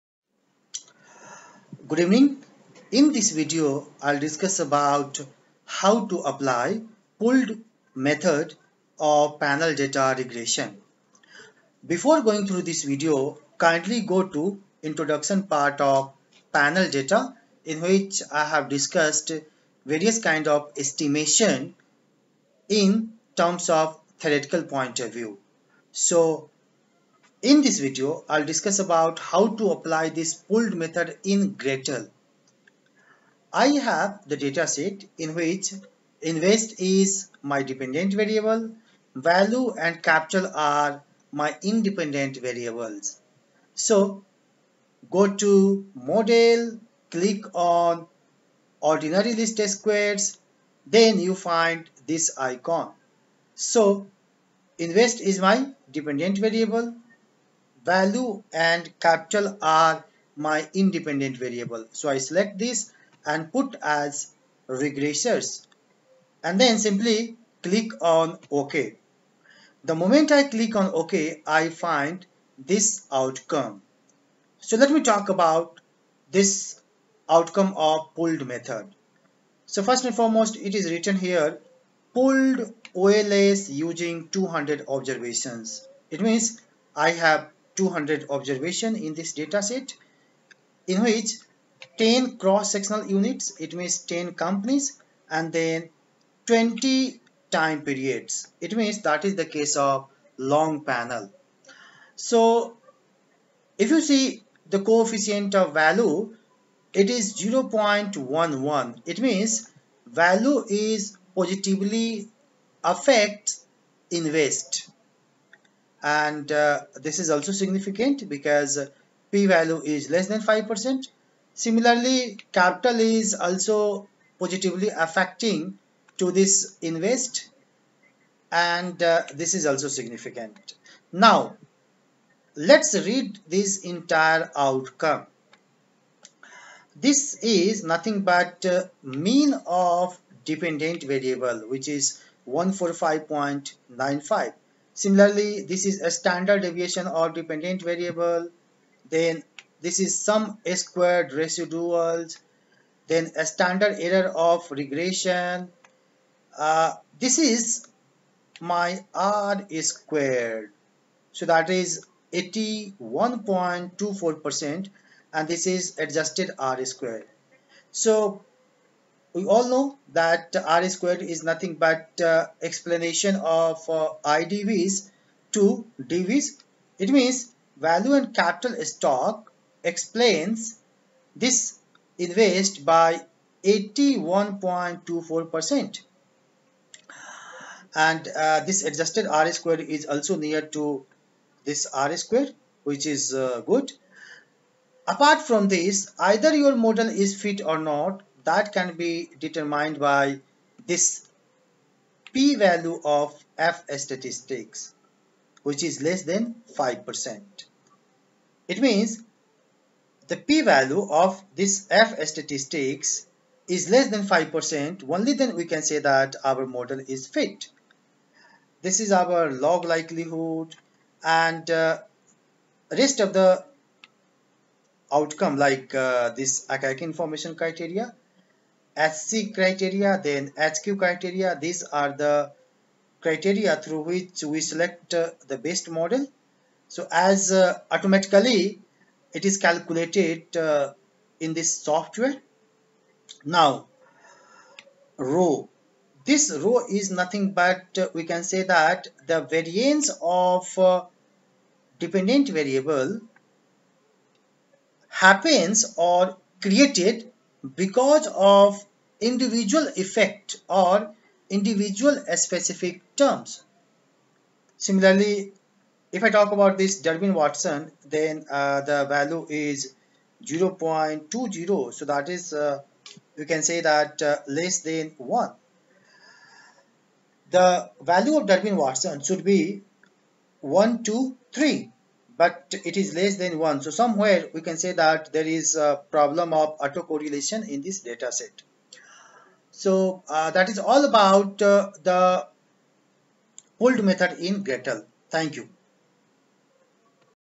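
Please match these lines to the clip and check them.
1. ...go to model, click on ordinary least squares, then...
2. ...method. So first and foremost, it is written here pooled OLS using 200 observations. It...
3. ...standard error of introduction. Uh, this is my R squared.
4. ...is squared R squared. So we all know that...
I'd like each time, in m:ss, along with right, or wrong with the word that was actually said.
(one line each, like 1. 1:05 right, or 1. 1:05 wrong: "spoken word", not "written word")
1. 0:45 right
2. 1:18 right
3. 2:33 wrong: "regression", not "introduction"
4. 2:45 wrong: "adjusted", not "squared".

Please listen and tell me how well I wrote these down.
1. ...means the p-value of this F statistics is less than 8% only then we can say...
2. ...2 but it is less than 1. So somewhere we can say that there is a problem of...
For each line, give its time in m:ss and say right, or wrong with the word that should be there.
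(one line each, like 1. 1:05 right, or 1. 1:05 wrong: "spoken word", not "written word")
1. 3:28 wrong: "5", not "8"
2. 4:41 wrong: "3", not "2".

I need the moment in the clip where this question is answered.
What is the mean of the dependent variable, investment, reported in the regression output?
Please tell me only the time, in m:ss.
2:22.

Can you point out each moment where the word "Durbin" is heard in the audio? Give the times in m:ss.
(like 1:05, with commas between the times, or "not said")
4:27, 4:38.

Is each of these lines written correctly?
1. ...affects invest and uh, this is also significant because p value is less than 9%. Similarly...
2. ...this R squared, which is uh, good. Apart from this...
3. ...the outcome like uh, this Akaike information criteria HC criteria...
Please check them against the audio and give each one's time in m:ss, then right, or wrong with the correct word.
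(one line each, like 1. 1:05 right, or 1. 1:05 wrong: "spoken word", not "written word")
1. 1:52 wrong: "5", not "9"
2. 3:11 right
3. 3:43 right.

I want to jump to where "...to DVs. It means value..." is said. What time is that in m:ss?
2:55.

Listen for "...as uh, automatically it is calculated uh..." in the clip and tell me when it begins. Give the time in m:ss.
3:57.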